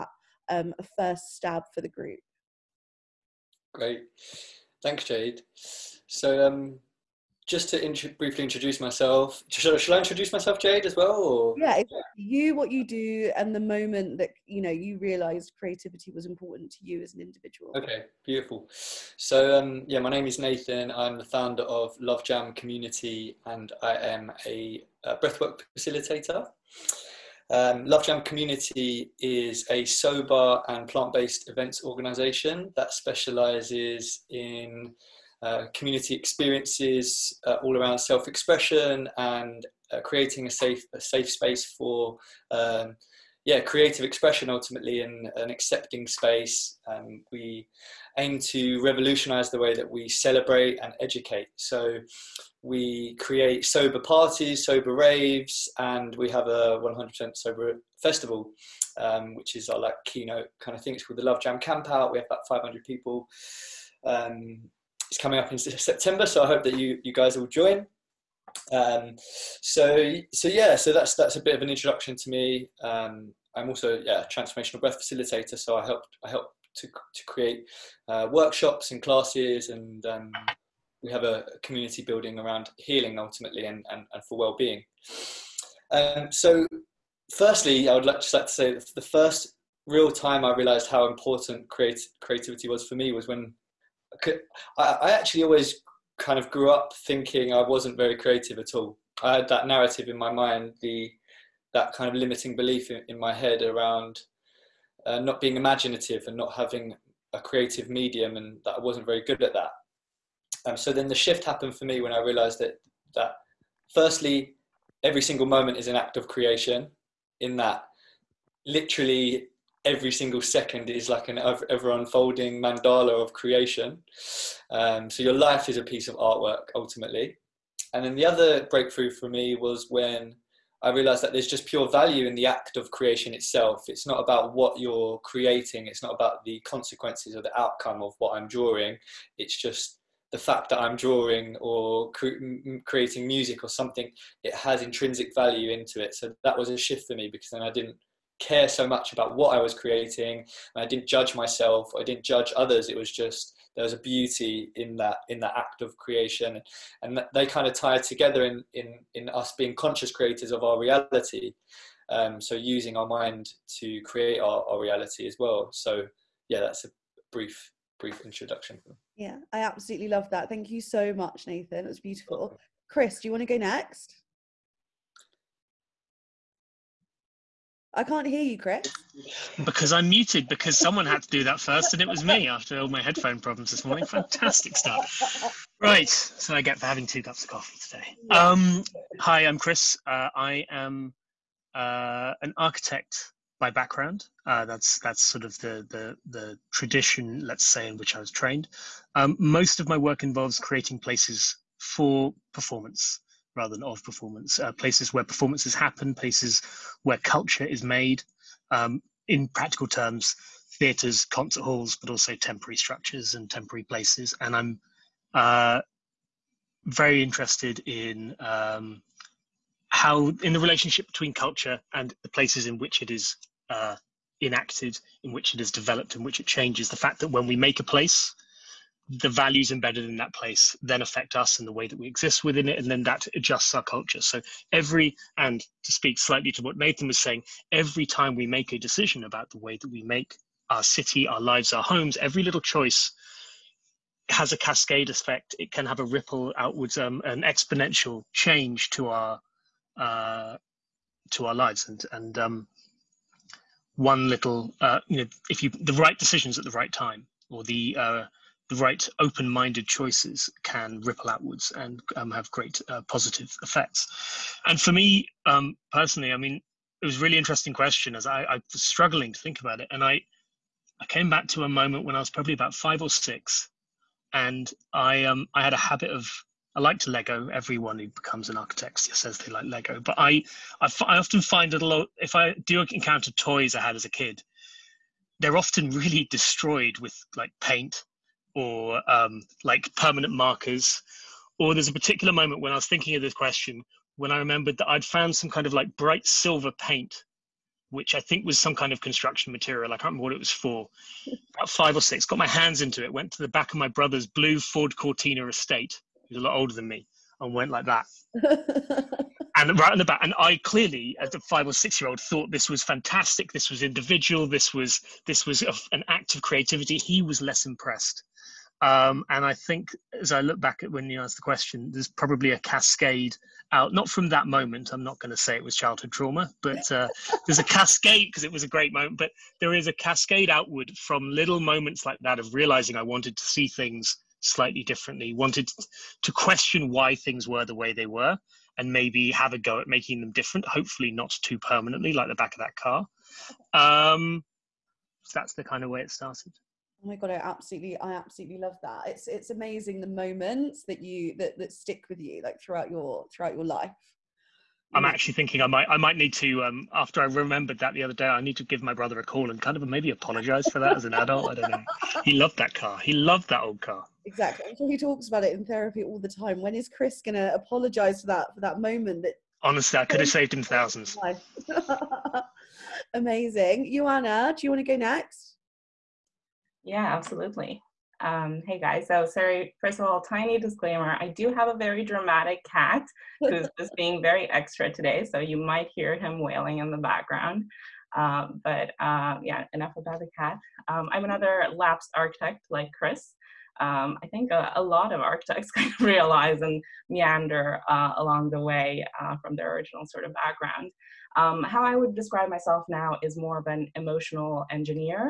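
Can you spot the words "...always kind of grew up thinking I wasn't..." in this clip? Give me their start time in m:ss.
1:35.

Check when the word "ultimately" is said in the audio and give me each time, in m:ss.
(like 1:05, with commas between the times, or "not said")
0:44, 1:23, 2:06.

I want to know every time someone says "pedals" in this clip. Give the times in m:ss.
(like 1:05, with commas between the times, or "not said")
not said.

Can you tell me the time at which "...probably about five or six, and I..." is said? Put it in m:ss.
4:32.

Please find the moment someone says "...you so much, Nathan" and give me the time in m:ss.
2:50.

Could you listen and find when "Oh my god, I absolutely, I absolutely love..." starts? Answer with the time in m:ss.
5:47.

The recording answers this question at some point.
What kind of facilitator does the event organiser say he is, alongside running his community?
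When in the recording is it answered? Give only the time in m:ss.
1:14.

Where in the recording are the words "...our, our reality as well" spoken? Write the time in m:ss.
2:44.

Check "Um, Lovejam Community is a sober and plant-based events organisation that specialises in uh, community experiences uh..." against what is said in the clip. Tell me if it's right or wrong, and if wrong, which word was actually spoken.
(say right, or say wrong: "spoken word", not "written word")
right.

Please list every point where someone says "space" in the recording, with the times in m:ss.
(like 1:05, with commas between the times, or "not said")
0:41, 0:46.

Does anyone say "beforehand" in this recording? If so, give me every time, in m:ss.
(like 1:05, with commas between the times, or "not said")
not said.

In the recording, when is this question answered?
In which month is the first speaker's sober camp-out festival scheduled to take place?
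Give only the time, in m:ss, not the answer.
1:05.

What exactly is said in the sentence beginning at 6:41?
Um, how I would describe myself now is more of an emotional engineer.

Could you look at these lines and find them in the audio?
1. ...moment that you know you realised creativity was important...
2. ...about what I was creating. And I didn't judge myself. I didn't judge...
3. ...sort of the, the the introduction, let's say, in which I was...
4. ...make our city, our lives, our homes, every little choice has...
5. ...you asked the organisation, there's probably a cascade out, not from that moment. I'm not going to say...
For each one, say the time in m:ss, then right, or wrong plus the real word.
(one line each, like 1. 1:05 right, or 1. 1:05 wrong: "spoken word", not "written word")
1. 0:13 right
2. 2:29 right
3. 3:15 wrong: "tradition", not "introduction"
4. 4:00 right
5. 5:21 wrong: "question", not "organisation".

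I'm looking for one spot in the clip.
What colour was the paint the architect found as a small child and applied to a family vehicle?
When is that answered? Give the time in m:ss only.
4:55.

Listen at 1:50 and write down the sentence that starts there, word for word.
Um, so then the shift happened for me when I realised that that firstly, every single moment is an act of creation.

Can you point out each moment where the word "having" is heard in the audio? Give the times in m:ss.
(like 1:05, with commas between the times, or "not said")
1:46, 3:06.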